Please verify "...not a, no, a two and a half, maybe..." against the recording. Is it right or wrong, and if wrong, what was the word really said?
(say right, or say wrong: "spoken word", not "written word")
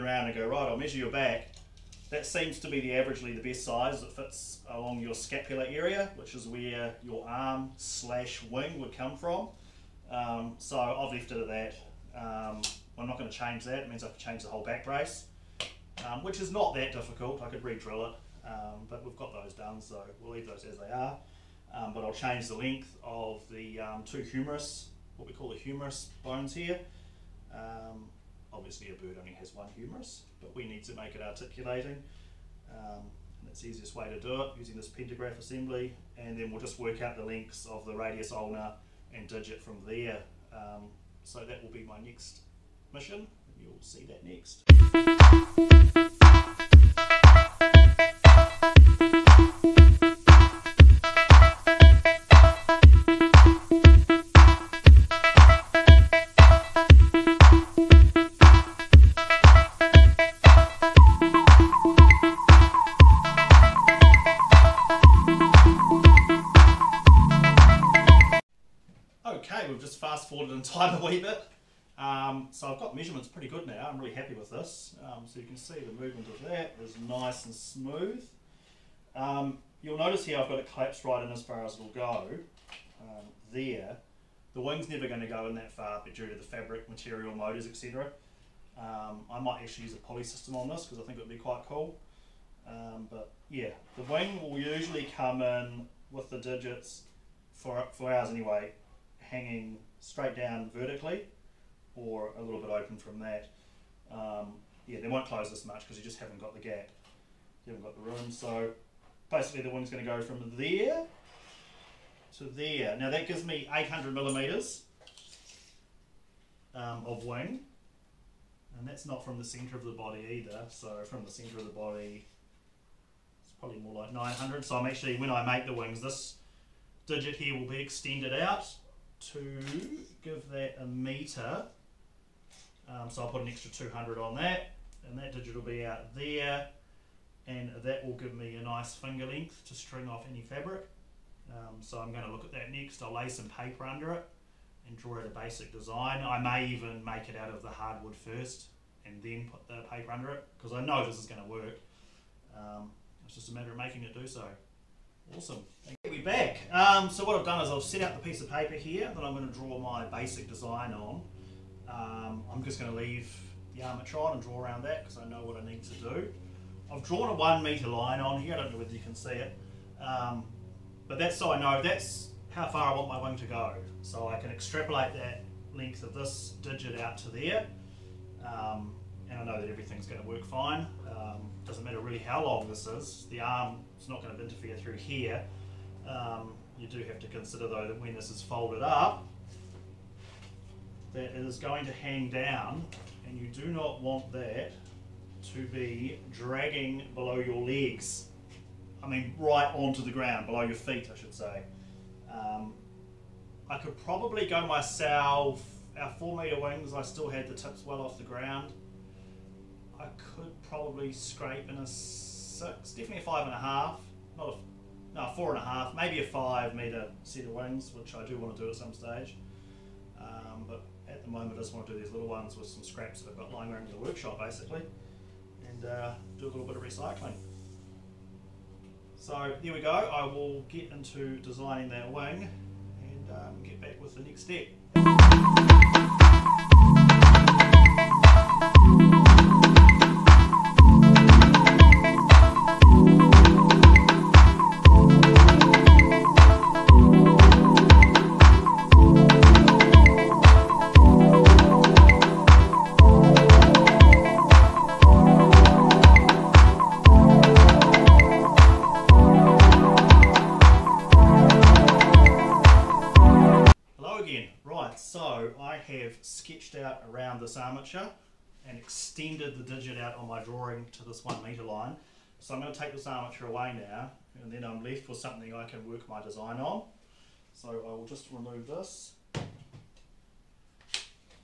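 wrong: "four", not "two".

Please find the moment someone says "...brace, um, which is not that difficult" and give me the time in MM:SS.
00:14.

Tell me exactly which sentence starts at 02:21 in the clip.
Um, so I'm going to look at that next.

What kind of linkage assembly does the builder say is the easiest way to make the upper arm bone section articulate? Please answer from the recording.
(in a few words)
pantograph.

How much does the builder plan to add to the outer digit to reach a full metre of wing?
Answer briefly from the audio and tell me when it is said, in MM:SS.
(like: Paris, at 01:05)
200, at 02:13.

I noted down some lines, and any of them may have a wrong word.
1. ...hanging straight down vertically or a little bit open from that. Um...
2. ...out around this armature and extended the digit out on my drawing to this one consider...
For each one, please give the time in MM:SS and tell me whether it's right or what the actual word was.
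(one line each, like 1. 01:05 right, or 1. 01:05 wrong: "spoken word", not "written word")
1. 01:39 right
2. 04:26 wrong: "meter", not "consider".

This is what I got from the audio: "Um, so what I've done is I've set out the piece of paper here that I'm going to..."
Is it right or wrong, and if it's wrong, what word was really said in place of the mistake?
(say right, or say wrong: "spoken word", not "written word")
right.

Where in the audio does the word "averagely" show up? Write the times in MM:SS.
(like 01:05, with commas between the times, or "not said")
00:02.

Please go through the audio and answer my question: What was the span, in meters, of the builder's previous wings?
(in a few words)
4 meter.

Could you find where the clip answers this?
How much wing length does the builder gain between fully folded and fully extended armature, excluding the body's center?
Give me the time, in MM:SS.
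01:53.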